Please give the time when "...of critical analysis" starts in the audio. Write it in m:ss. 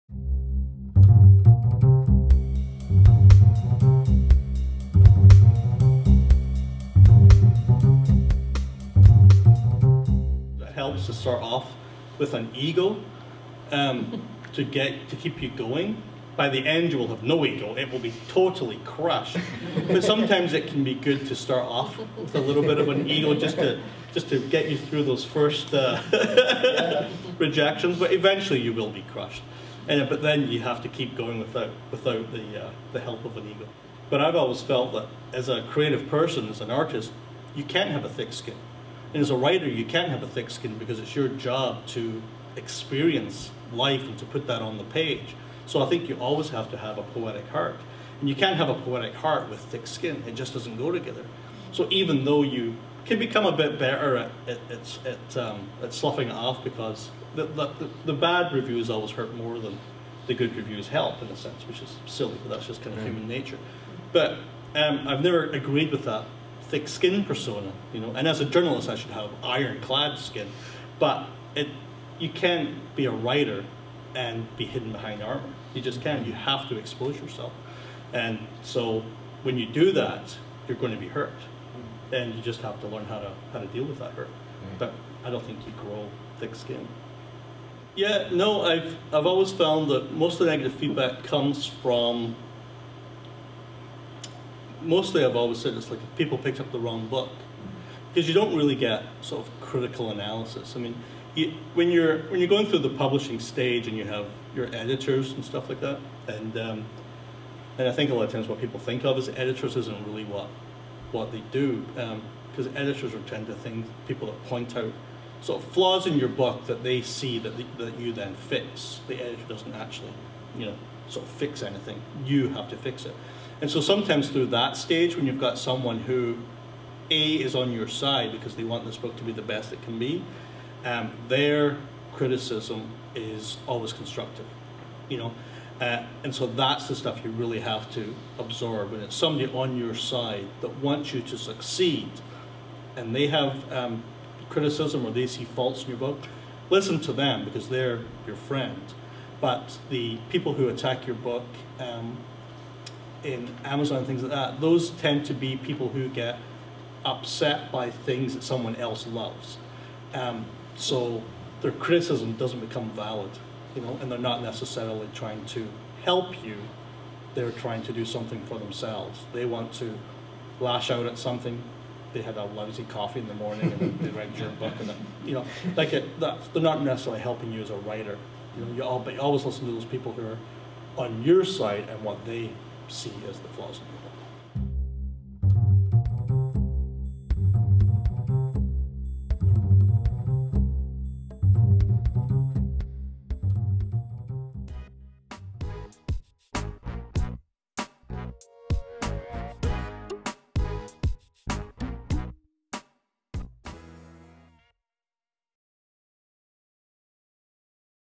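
1:39.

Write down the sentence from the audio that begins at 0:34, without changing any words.
But I've always felt that as a creative person, as an artist, you can't have a thick skin.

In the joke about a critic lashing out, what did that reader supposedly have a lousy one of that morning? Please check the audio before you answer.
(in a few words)
Coffee.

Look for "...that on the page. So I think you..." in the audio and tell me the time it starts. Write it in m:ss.
0:44.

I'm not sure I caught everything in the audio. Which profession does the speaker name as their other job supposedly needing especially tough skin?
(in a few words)
Journalist.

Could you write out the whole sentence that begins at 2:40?
Um, so their criticism doesn't become valid, you know, and they're not necessarily trying to help you.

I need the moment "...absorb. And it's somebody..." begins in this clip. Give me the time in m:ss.
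2:18.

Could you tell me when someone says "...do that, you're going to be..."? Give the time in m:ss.
1:19.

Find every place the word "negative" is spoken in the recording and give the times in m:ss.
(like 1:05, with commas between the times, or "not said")
1:30.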